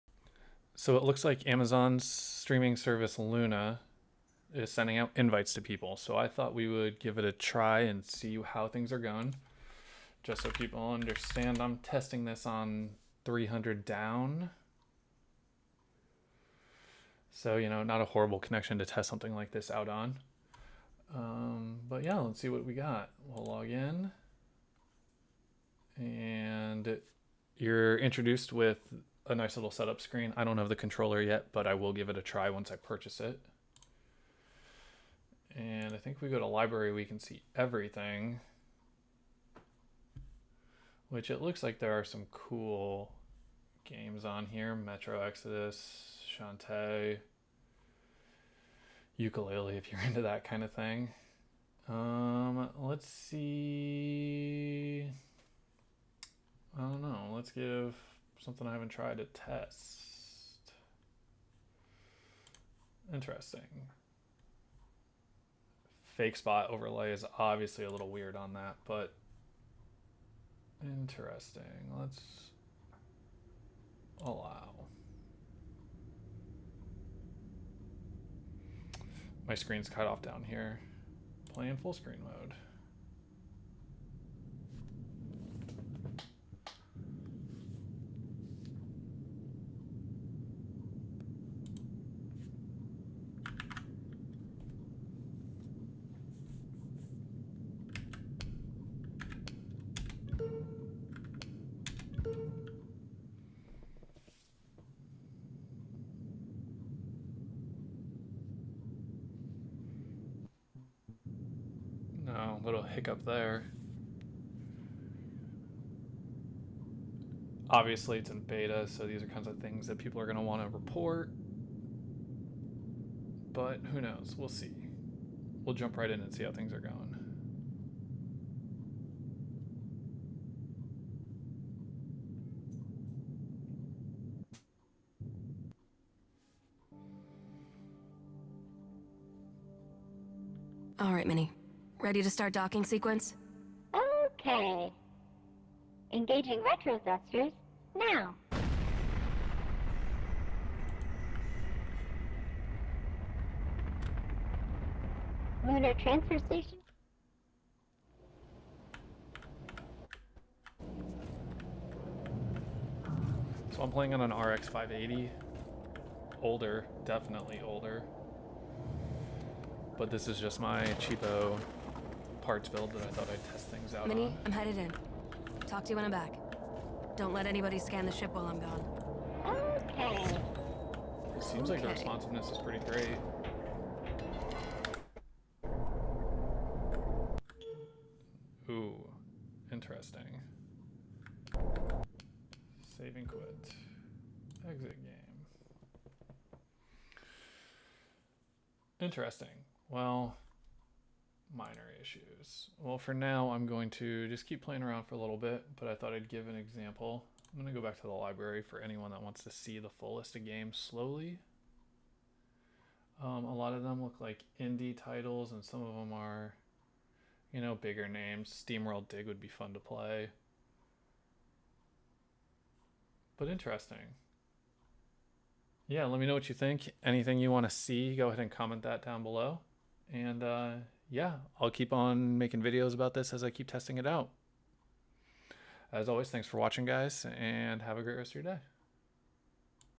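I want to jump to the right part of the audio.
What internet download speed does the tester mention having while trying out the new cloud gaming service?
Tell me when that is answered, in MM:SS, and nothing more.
00:13.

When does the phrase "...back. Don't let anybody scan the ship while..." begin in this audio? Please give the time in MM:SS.
02:56.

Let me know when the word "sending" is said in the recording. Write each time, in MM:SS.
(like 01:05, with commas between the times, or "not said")
00:04.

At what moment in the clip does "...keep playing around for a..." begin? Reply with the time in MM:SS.
03:24.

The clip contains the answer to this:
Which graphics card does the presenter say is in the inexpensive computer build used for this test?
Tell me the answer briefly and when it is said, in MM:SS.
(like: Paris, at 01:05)
RX 580, at 02:44.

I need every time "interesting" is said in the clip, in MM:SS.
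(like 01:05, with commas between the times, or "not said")
01:03, 01:10, 03:09, 03:19, 03:43.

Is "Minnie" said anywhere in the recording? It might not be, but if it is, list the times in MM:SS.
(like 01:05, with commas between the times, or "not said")
02:21, 02:54.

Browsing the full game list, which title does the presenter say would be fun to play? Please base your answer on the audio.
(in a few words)
SteamWorld Dig.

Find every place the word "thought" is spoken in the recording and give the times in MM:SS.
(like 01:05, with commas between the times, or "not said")
00:06, 02:53, 03:25.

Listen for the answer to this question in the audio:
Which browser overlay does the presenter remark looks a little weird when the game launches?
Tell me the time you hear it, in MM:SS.
01:06.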